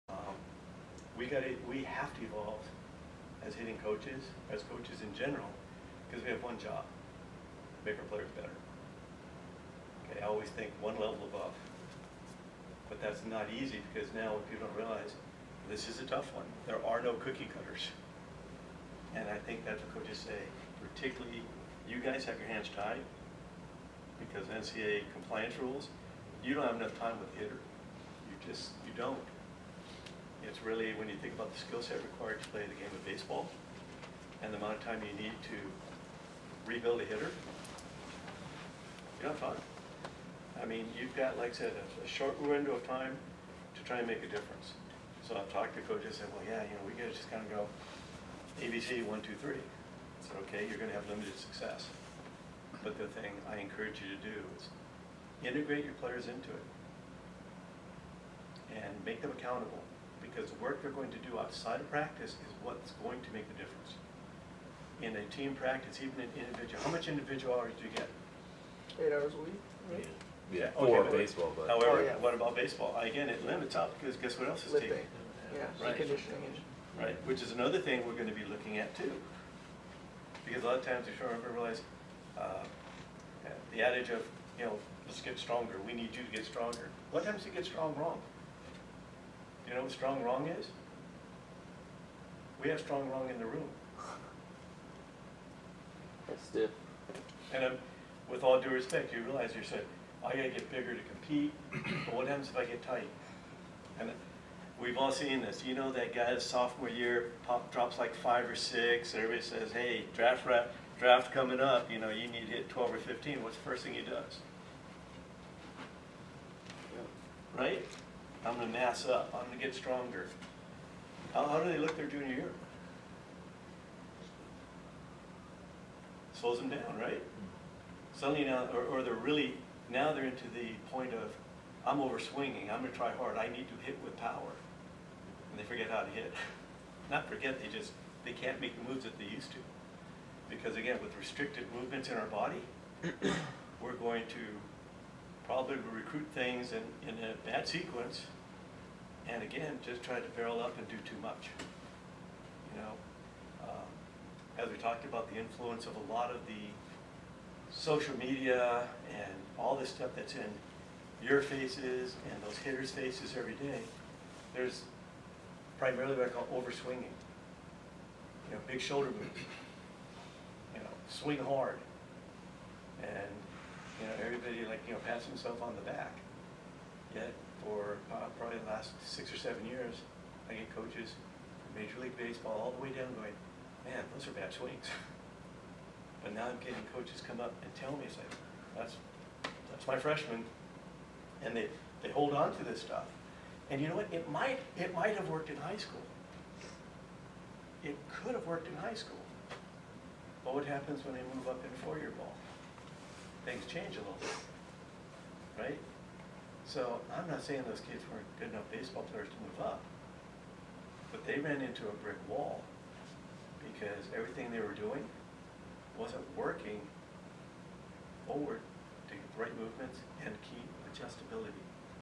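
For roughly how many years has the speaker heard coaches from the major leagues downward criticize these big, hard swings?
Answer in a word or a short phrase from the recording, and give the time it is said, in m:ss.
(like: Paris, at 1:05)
6 or 7 years, at 2:59.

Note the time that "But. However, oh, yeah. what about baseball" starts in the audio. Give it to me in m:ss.
1:11.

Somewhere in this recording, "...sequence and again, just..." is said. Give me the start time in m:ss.
2:27.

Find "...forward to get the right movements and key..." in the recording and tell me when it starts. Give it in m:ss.
3:38.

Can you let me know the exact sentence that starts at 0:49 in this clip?
I said, okay, you're going to have limited success.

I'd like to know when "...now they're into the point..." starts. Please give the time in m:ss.
2:09.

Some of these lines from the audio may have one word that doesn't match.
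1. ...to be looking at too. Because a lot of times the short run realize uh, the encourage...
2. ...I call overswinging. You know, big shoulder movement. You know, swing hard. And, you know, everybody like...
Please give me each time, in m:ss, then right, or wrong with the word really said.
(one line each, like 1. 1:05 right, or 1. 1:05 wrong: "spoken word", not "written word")
1. 1:18 wrong: "adage", not "encourage"
2. 2:46 right.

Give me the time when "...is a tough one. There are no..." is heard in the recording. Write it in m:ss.
0:15.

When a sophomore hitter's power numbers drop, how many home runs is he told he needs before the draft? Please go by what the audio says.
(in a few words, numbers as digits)
12 or 15.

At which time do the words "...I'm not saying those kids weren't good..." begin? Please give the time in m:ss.
3:27.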